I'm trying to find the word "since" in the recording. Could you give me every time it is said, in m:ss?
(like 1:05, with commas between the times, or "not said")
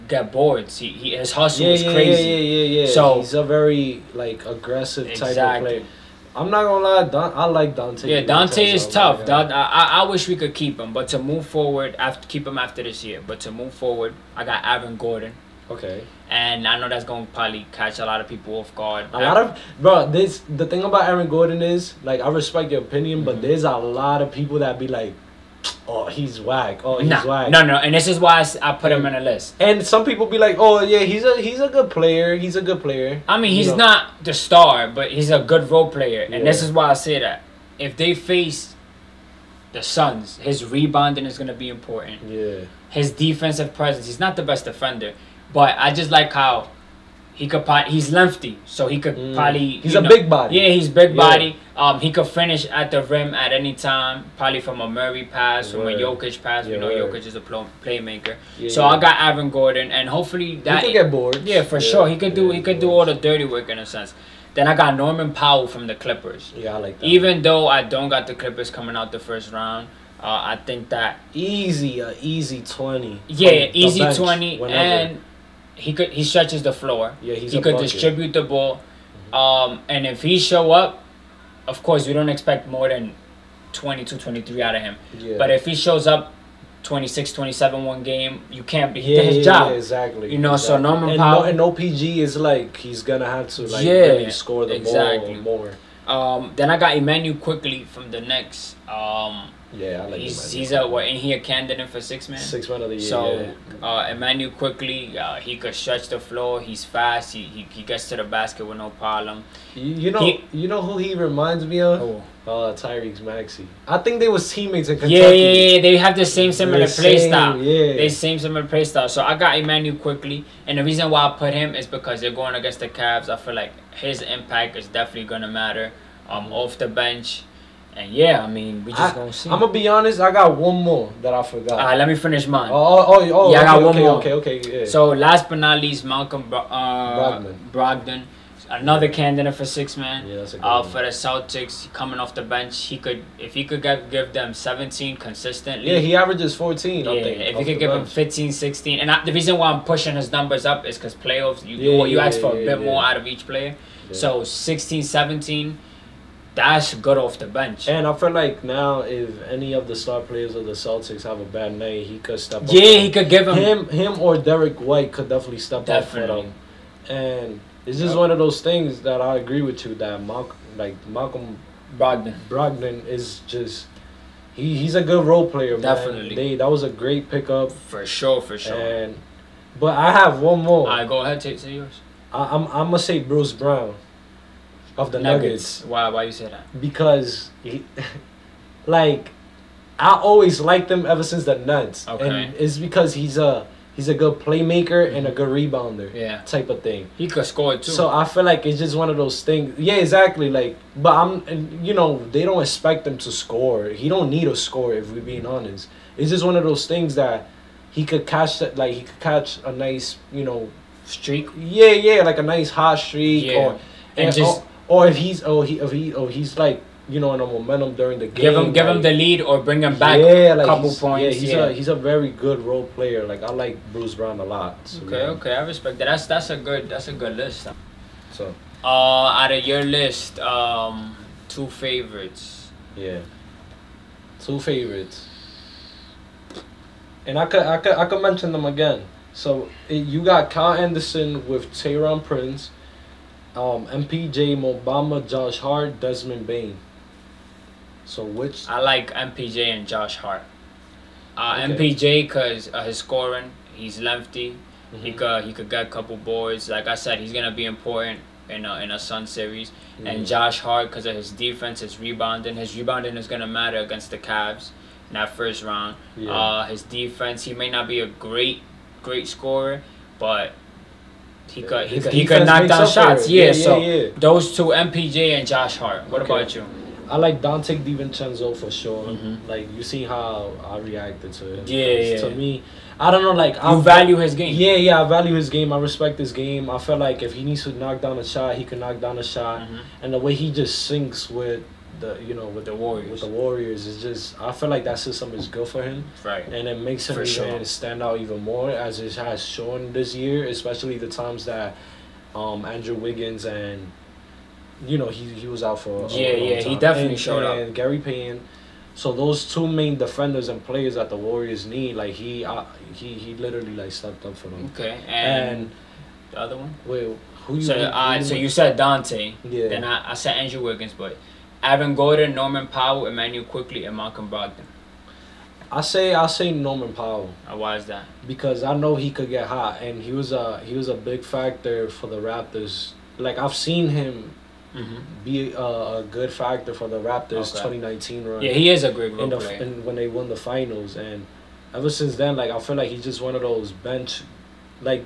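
3:11, 5:41.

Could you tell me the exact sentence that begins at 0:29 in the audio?
And some people be like, oh yeah, he's a he's a good player.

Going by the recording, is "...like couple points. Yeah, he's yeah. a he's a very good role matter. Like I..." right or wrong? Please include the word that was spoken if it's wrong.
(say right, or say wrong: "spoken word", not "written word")
wrong: "player", not "matter".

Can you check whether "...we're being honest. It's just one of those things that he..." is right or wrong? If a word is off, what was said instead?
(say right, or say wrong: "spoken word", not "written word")
right.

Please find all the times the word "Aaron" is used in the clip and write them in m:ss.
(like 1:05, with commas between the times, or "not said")
0:14, 0:21, 0:59, 5:21.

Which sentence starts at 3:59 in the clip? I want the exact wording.
So it, you got Kyle Anderson with Taurean Prince um, MPJ Mobamba, Josh Hart, Desmond Bane.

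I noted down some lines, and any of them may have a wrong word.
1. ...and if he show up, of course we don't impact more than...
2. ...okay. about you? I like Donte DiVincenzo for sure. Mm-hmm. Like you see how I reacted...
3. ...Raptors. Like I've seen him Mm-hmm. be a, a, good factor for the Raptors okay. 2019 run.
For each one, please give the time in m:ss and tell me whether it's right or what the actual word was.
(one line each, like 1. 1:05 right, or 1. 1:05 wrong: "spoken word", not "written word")
1. 1:19 wrong: "expect", not "impact"
2. 4:36 right
3. 5:32 right.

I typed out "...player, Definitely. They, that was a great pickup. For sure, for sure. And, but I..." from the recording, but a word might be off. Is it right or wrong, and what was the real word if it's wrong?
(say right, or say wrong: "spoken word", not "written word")
right.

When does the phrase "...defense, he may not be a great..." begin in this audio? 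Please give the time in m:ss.
4:26.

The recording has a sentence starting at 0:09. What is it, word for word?
Don, I, I wish we could keep him, but to move forward, after keep him after this year.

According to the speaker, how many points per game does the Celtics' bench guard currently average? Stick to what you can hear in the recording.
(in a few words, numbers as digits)
14.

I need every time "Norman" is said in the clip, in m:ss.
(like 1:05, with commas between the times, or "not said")
1:04, 1:30, 5:22, 5:26.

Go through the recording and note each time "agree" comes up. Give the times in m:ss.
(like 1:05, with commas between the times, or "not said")
2:49.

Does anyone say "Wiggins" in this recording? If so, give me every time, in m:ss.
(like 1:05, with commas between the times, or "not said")
5:02, 5:20.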